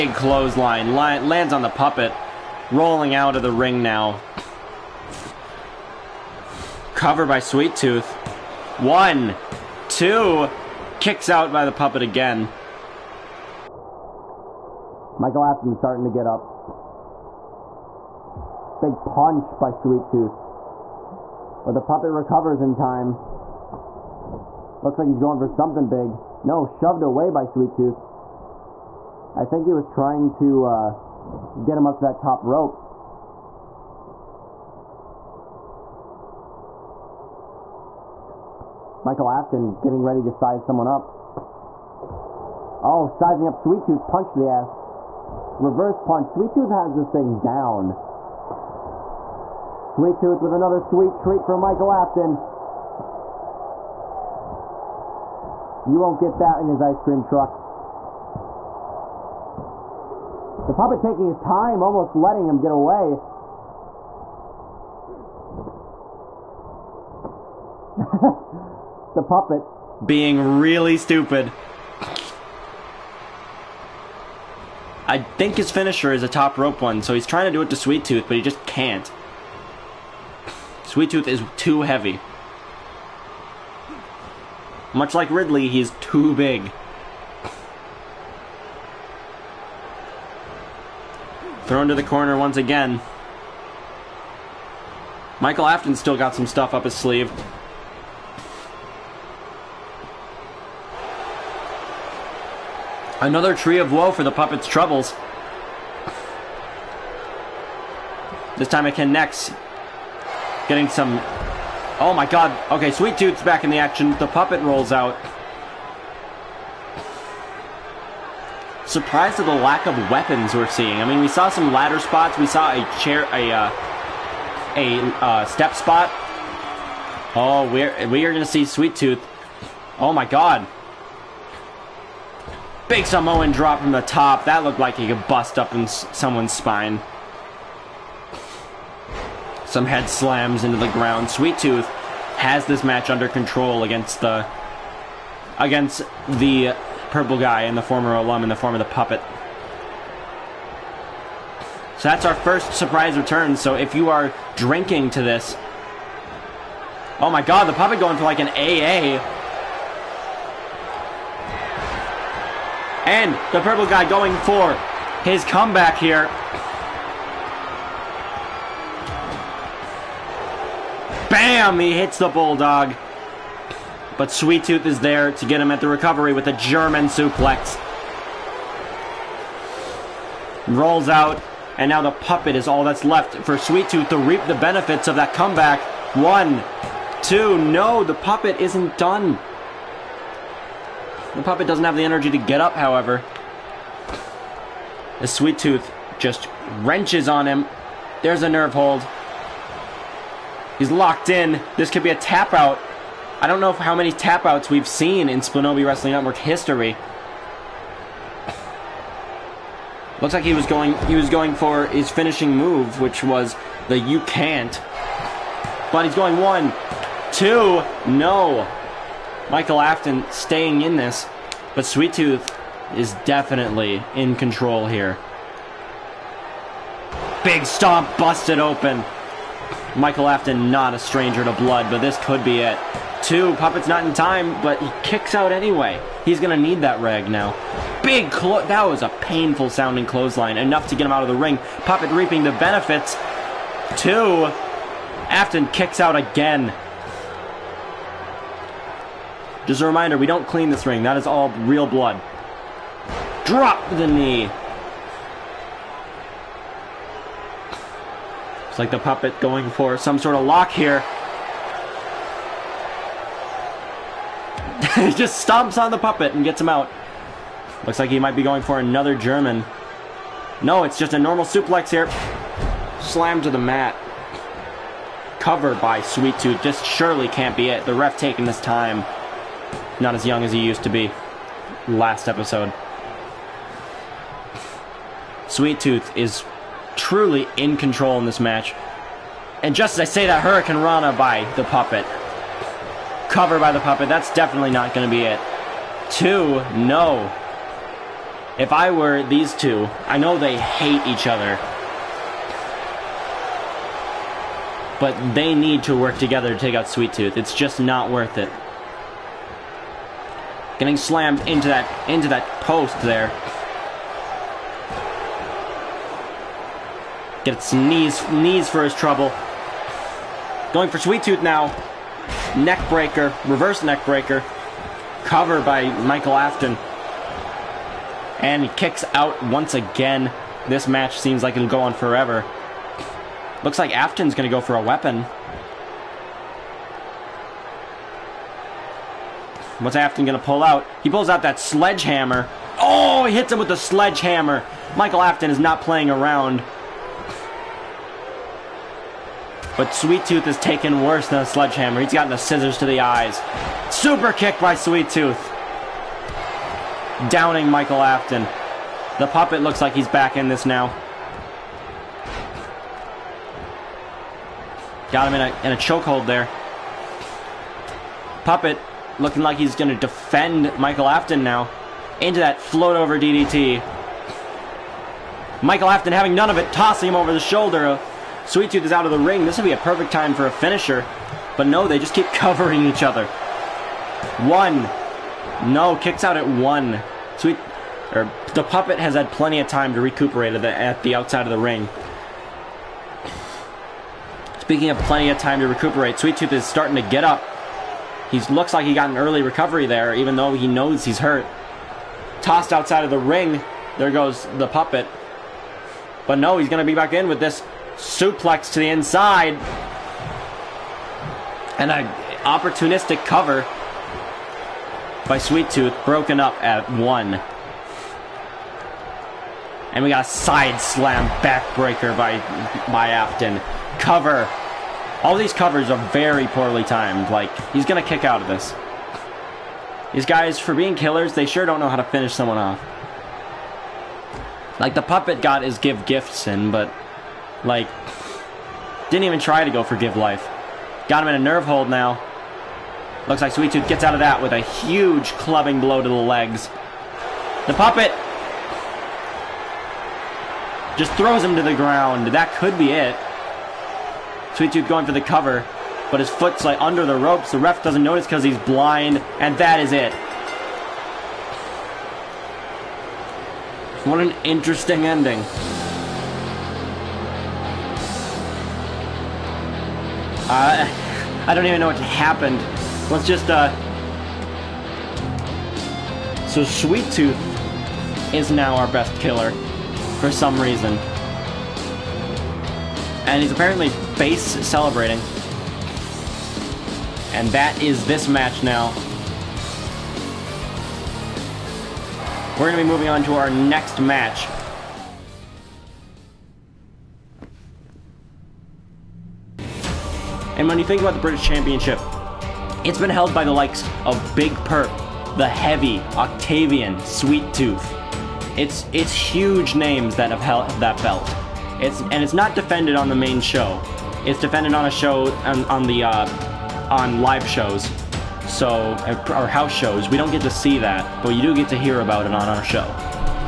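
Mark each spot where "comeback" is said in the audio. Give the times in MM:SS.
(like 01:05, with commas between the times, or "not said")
02:45, 03:05.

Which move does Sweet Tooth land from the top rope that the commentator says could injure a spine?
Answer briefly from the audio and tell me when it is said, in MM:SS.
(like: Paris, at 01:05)
Samoan drop, at 02:13.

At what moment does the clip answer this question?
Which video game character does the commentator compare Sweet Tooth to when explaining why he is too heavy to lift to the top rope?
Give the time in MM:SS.
01:25.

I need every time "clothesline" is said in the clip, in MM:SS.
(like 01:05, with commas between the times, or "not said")
00:00, 04:00.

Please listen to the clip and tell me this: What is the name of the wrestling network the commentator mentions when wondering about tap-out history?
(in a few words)
Splinobi Wrestling Network.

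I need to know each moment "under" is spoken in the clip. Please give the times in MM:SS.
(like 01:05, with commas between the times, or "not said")
02:23, 07:36.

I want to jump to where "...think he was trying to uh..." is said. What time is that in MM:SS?
00:29.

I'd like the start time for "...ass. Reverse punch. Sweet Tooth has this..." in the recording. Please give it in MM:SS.
00:44.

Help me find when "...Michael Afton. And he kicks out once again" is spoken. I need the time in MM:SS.
05:26.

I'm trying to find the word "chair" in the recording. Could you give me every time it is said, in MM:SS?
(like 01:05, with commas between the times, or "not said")
02:02.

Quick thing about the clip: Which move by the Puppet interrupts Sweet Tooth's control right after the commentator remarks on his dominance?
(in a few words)
Hurricane Rana.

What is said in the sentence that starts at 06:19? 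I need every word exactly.
This would be a perfect time for a finisher.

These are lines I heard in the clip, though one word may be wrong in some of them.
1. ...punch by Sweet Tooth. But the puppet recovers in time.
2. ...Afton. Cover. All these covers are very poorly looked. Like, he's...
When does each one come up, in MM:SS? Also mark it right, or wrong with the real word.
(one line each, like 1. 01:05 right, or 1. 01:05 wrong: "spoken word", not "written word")
1. 00:19 right
2. 07:03 wrong: "timed", not "looked".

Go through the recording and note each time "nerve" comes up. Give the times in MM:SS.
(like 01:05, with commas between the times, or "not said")
03:18, 07:21.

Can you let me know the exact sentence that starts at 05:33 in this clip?
Looks like Afton's going to go for a weapon.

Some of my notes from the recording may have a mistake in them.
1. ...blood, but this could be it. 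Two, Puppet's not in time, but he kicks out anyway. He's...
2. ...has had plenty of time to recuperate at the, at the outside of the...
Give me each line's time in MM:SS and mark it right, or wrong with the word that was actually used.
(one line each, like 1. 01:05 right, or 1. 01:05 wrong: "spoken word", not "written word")
1. 03:51 right
2. 06:28 right.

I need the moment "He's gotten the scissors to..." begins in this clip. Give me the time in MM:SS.
05:52.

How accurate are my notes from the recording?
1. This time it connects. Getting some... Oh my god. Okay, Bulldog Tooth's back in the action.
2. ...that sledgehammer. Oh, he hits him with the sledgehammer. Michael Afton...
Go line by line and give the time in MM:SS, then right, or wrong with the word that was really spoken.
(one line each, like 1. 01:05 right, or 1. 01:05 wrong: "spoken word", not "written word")
1. 01:48 wrong: "Sweet", not "Bulldog"
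2. 05:41 right.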